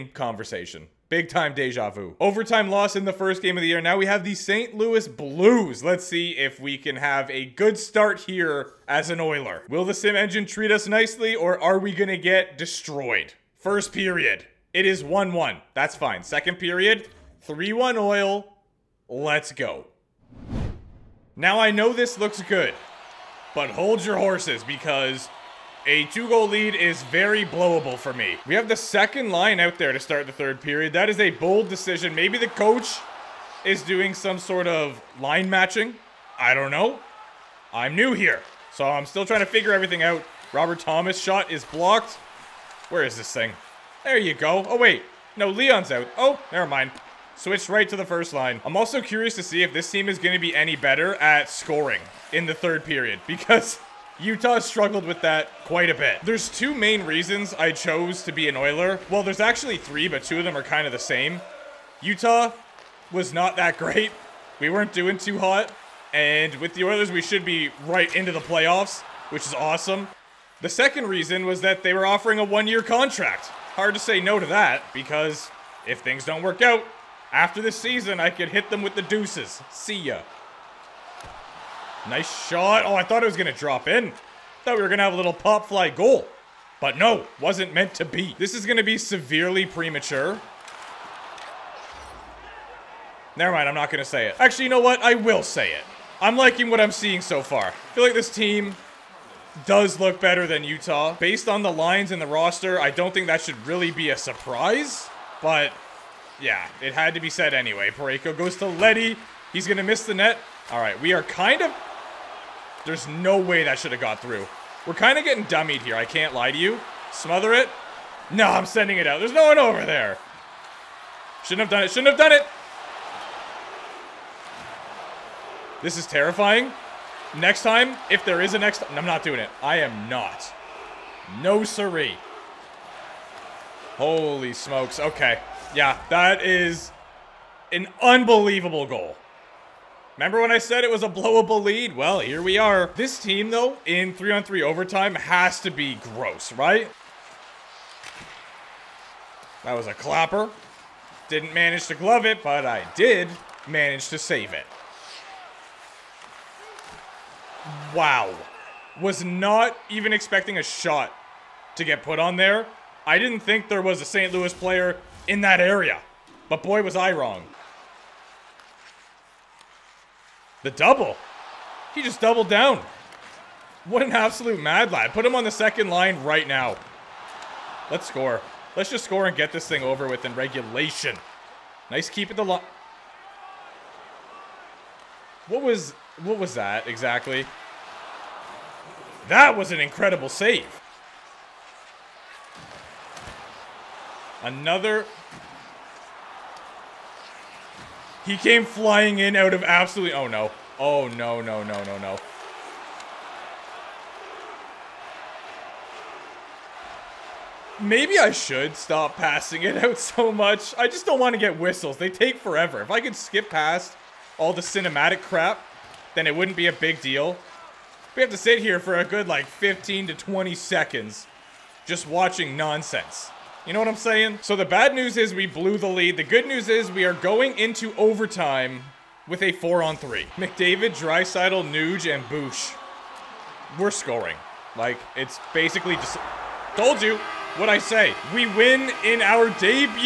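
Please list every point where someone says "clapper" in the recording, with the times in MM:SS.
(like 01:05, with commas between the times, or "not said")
02:29.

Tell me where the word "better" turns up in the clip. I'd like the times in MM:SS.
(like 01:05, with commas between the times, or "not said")
00:50, 01:40.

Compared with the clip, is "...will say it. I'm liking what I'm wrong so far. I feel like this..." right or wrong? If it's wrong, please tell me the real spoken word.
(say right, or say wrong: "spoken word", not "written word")
wrong: "seeing", not "wrong".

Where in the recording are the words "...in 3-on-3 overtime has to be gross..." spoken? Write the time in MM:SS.
02:23.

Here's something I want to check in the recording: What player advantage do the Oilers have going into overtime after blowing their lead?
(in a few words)
4-on-3.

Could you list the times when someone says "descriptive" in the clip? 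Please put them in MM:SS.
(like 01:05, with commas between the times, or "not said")
not said.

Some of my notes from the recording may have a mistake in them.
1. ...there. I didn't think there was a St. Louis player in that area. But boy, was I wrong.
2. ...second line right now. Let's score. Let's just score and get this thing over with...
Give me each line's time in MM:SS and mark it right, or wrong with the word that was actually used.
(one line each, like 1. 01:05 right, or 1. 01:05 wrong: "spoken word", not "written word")
1. 02:42 right
2. 02:55 right.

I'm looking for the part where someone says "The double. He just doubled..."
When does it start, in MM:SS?
02:50.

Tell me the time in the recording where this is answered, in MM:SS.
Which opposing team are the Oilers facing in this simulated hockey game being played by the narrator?
00:04.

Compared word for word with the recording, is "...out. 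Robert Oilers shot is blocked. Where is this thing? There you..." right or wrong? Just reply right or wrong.
wrong.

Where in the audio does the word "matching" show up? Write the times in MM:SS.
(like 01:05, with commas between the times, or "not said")
00:35.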